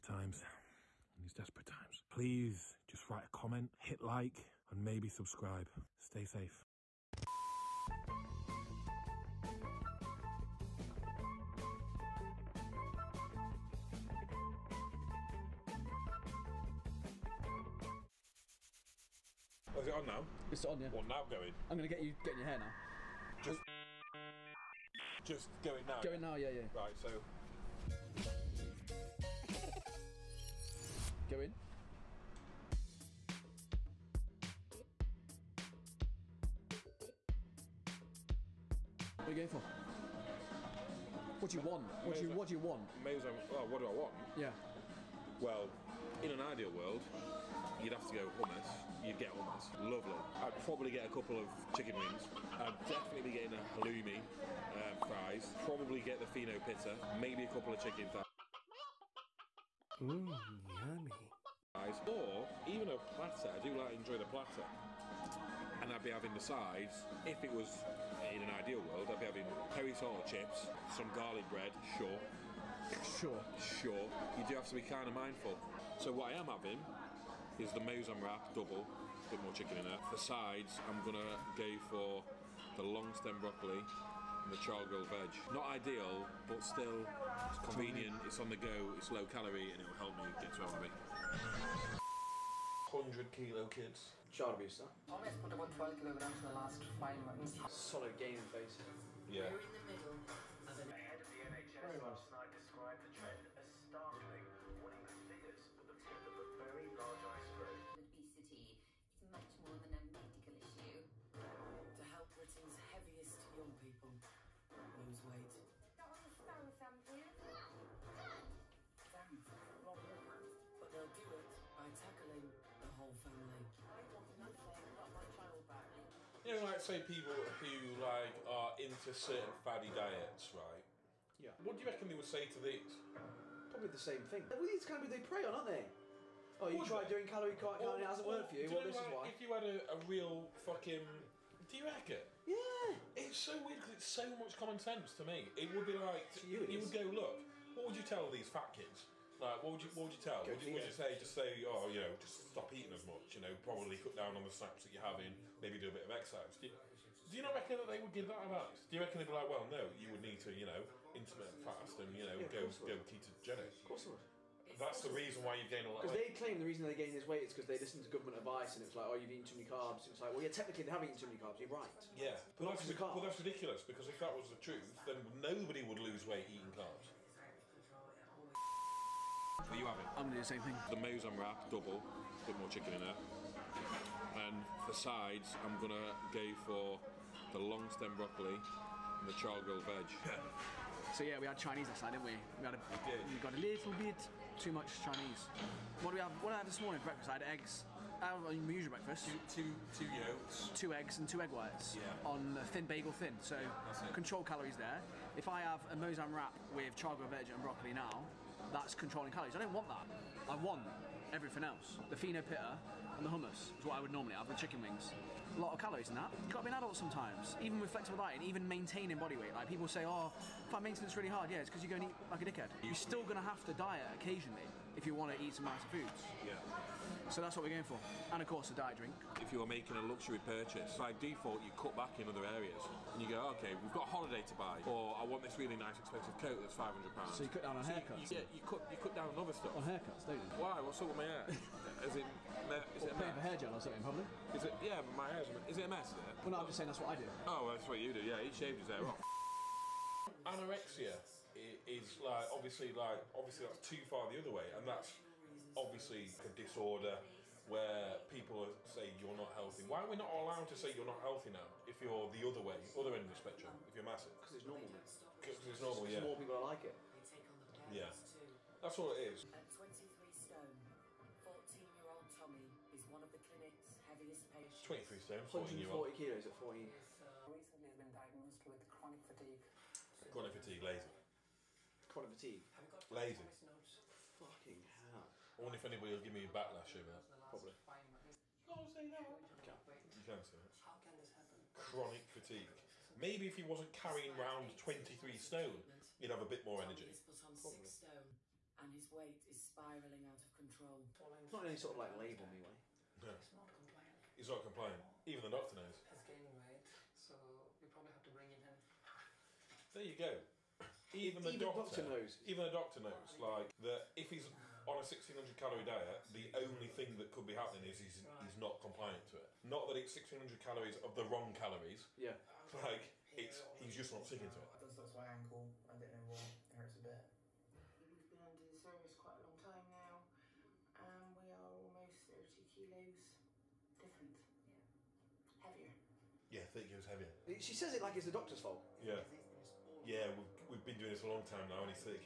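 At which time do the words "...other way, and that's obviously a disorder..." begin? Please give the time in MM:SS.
04:14.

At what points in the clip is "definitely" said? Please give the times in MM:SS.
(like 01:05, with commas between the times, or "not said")
00:52.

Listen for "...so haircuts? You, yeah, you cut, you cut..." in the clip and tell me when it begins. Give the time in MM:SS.
03:57.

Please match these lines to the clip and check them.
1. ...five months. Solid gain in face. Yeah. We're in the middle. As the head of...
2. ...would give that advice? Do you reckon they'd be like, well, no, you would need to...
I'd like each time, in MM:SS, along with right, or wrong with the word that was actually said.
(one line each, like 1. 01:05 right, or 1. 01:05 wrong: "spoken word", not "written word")
1. 01:36 right
2. 02:38 right.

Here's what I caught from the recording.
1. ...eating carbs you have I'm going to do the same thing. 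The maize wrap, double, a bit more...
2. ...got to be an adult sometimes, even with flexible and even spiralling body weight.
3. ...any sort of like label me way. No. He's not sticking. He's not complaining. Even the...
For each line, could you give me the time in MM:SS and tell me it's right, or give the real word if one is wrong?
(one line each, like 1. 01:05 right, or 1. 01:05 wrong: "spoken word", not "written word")
1. 02:56 right
2. 03:36 wrong: "maintaining", not "spiralling"
3. 05:01 wrong: "complaining", not "sticking".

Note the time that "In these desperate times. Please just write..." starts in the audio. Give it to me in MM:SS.
00:01.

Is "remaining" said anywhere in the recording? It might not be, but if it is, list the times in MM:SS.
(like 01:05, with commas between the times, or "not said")
not said.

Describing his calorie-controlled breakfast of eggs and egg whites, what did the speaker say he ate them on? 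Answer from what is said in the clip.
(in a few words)
bagel thin.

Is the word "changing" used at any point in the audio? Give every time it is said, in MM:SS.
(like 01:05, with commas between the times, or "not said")
not said.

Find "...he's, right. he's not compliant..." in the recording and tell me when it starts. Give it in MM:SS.
05:18.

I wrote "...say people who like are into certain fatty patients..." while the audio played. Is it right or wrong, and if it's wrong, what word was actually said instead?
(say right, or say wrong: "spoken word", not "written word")
wrong: "diets", not "patients".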